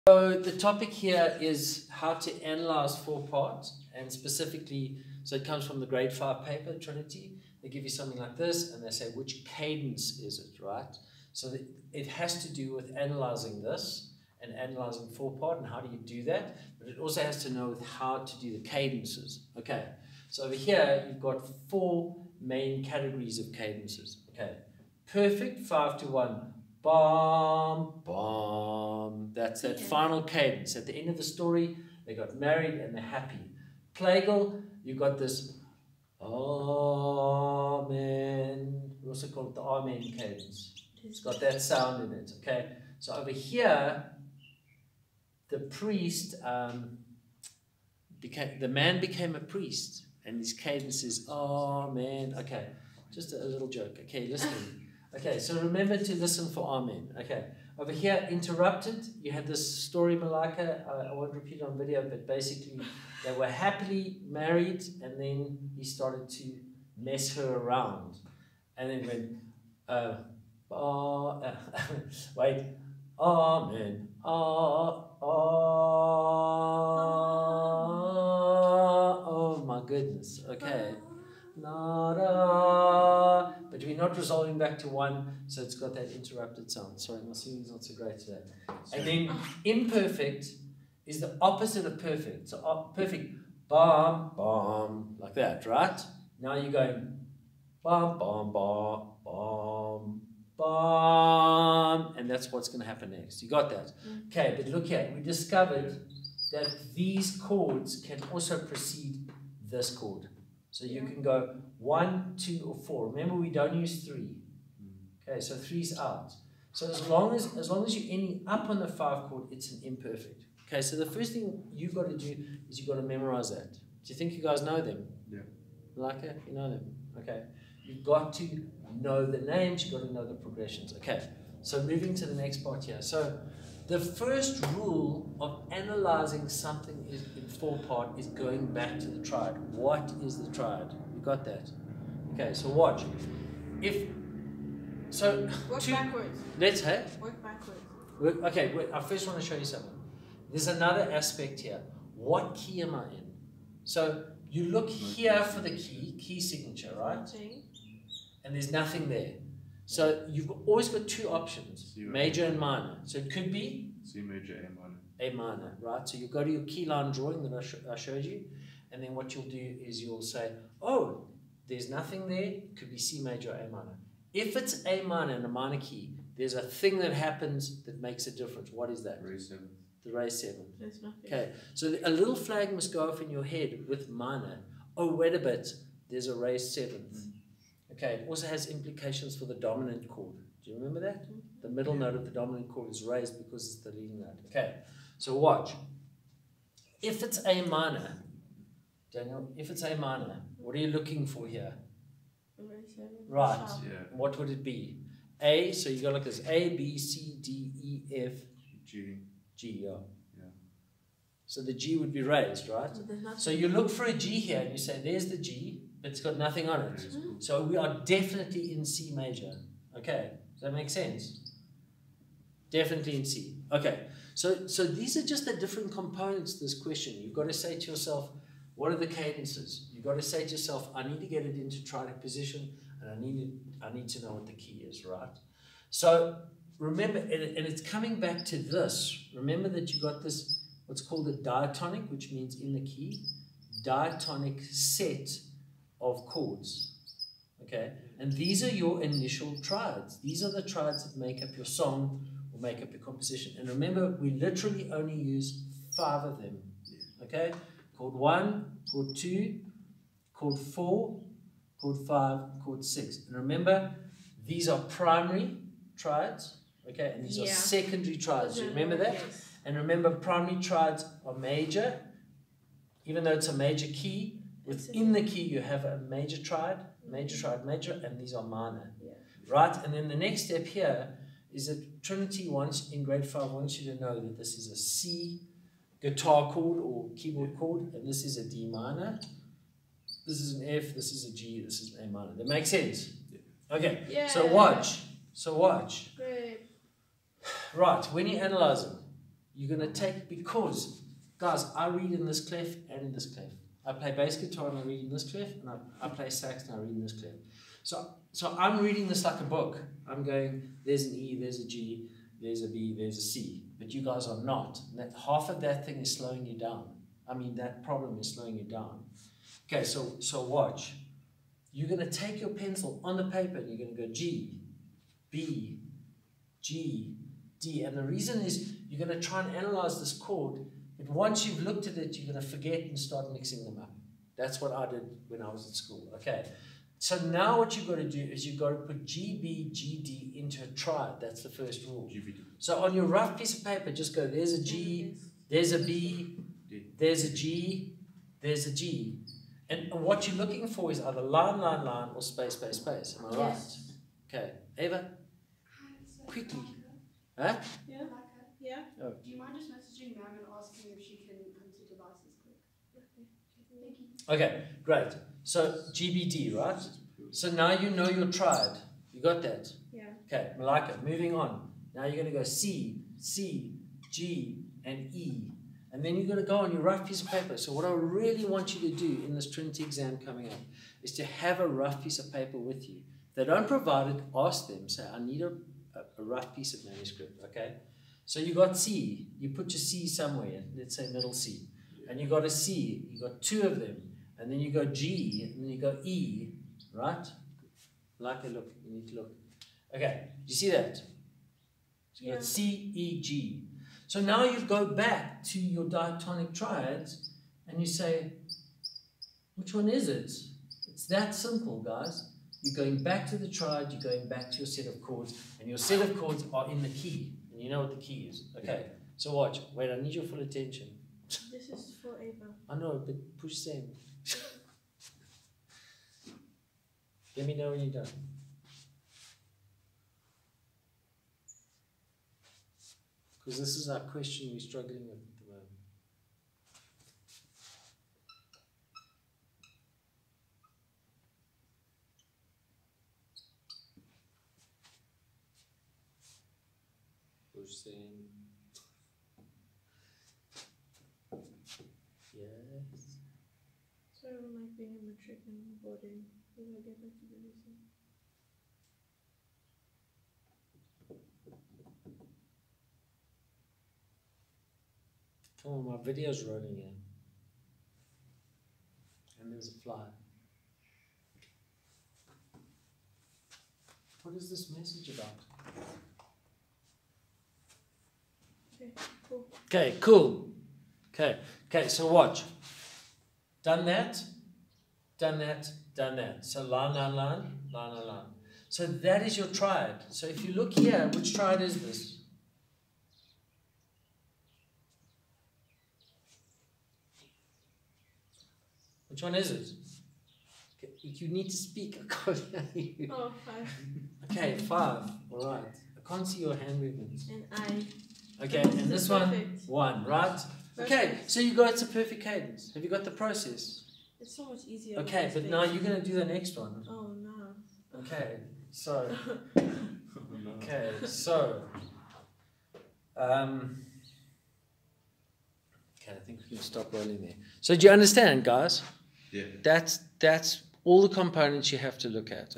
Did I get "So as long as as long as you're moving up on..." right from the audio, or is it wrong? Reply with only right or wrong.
wrong.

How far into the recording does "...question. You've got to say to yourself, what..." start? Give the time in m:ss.
3:46.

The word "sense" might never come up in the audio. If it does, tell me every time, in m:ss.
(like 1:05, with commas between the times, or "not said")
3:40, 4:52.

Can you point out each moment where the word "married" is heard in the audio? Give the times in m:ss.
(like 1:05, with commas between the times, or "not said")
0:32, 1:04.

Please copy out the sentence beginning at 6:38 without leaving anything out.
Like a look, you need to look.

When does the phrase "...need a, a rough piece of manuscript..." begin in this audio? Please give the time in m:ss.
6:25.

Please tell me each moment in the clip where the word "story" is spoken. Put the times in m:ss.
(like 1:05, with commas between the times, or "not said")
0:31, 0:59.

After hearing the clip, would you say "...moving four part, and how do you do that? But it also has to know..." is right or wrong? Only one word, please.
wrong.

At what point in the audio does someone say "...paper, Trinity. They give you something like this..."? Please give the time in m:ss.
0:06.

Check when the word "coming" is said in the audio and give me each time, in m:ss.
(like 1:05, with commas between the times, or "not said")
3:57, 6:20.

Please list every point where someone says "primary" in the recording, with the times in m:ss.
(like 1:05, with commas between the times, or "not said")
4:24, 4:30.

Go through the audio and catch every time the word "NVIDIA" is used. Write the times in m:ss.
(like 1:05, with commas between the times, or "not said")
not said.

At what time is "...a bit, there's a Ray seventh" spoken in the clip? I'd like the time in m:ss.
3:05.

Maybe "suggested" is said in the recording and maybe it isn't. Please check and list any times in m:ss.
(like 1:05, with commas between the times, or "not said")
not said.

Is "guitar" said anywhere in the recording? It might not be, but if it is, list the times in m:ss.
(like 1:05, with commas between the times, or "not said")
4:46, 5:04.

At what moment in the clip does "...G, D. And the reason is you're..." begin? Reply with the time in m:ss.
5:26.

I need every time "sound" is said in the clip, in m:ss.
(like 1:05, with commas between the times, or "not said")
0:41, 1:26.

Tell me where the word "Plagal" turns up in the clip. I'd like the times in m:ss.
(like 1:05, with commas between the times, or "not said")
0:33.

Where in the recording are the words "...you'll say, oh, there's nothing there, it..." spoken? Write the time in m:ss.
2:50.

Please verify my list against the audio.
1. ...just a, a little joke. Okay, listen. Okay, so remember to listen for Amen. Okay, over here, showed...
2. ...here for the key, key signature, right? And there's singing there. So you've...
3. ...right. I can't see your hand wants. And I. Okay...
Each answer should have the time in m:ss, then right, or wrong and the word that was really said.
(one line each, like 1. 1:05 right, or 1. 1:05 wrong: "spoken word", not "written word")
1. 0:53 wrong: "interrupted", not "showed"
2. 2:34 wrong: "nothing", not "singing"
3. 8:25 wrong: "movements", not "wants".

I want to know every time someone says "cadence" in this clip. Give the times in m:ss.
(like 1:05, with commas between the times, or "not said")
0:09, 0:18, 0:23, 0:30, 0:40, 0:50, 3:49, 8:32.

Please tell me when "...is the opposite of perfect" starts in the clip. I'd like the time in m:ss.
1:31.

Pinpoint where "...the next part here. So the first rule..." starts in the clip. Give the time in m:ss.
2:12.